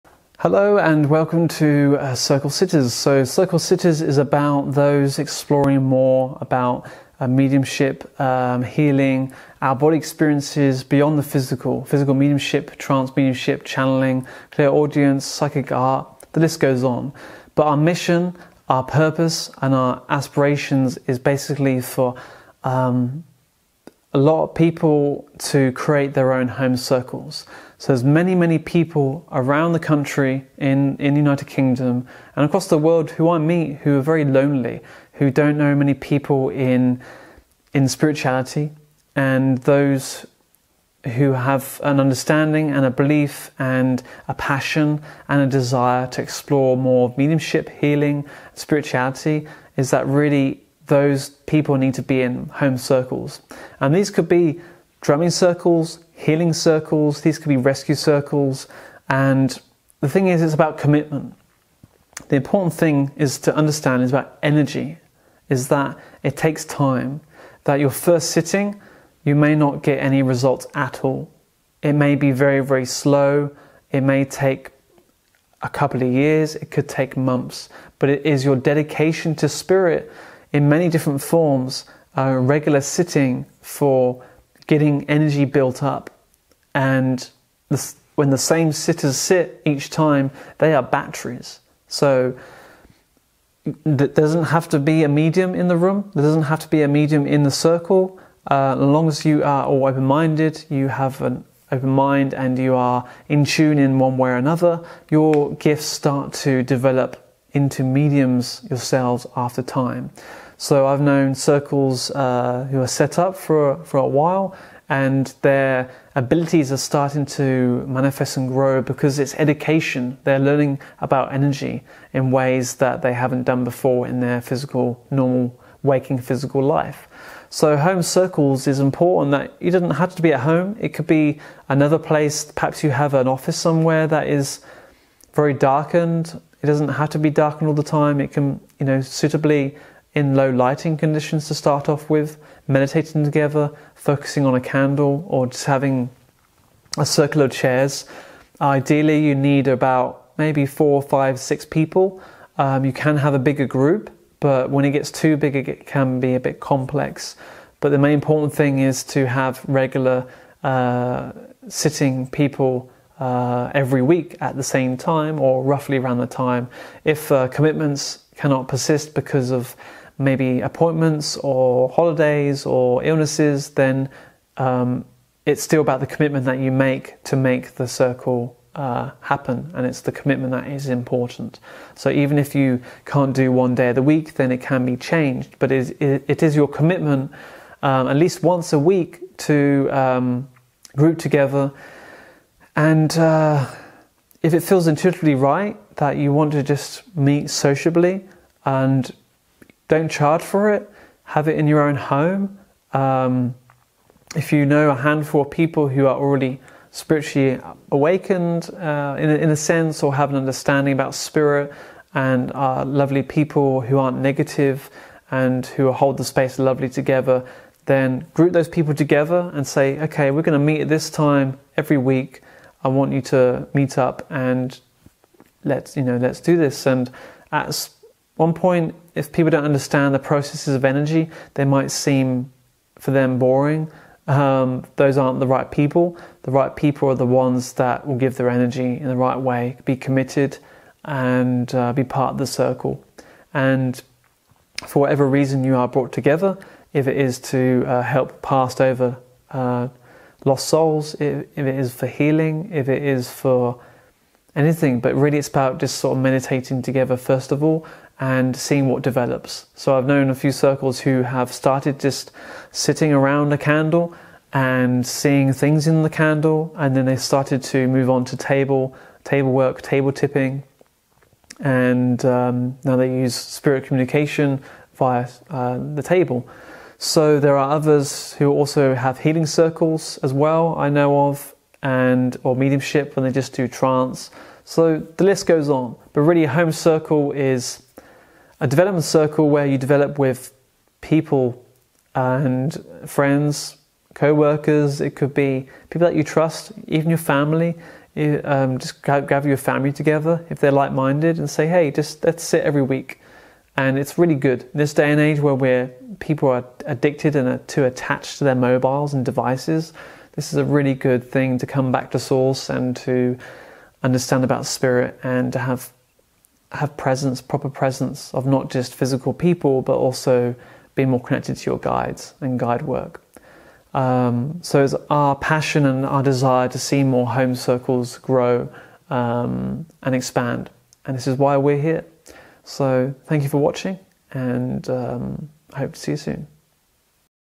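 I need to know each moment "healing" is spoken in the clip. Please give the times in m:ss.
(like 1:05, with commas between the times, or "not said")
0:08, 0:47, 0:56, 4:12, 4:39.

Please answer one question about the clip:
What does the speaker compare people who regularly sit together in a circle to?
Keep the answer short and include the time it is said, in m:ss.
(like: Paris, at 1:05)
batteries, at 1:30.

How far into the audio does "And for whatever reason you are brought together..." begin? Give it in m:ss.
4:03.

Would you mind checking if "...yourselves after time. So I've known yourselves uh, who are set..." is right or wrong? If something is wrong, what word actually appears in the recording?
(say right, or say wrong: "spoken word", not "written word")
wrong: "circles", not "yourselves".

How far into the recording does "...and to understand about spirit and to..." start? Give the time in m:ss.
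5:12.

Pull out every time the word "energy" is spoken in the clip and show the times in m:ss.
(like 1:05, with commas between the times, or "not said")
1:04, 1:25, 2:01, 3:50, 3:58.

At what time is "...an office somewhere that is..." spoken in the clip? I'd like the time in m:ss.
2:13.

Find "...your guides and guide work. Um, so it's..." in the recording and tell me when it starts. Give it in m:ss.
5:21.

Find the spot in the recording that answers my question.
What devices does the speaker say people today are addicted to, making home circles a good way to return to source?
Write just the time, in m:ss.
5:08.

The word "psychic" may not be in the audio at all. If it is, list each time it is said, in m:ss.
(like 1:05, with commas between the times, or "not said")
0:15.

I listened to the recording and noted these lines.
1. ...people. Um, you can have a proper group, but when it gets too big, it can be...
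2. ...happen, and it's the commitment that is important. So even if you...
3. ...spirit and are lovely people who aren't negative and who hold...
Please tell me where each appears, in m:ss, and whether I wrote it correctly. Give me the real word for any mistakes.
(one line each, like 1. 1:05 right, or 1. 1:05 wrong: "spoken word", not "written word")
1. 2:31 wrong: "bigger", not "proper"
2. 2:59 right
3. 3:31 right.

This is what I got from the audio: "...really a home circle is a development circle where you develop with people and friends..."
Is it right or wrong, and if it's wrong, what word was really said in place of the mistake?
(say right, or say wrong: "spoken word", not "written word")
right.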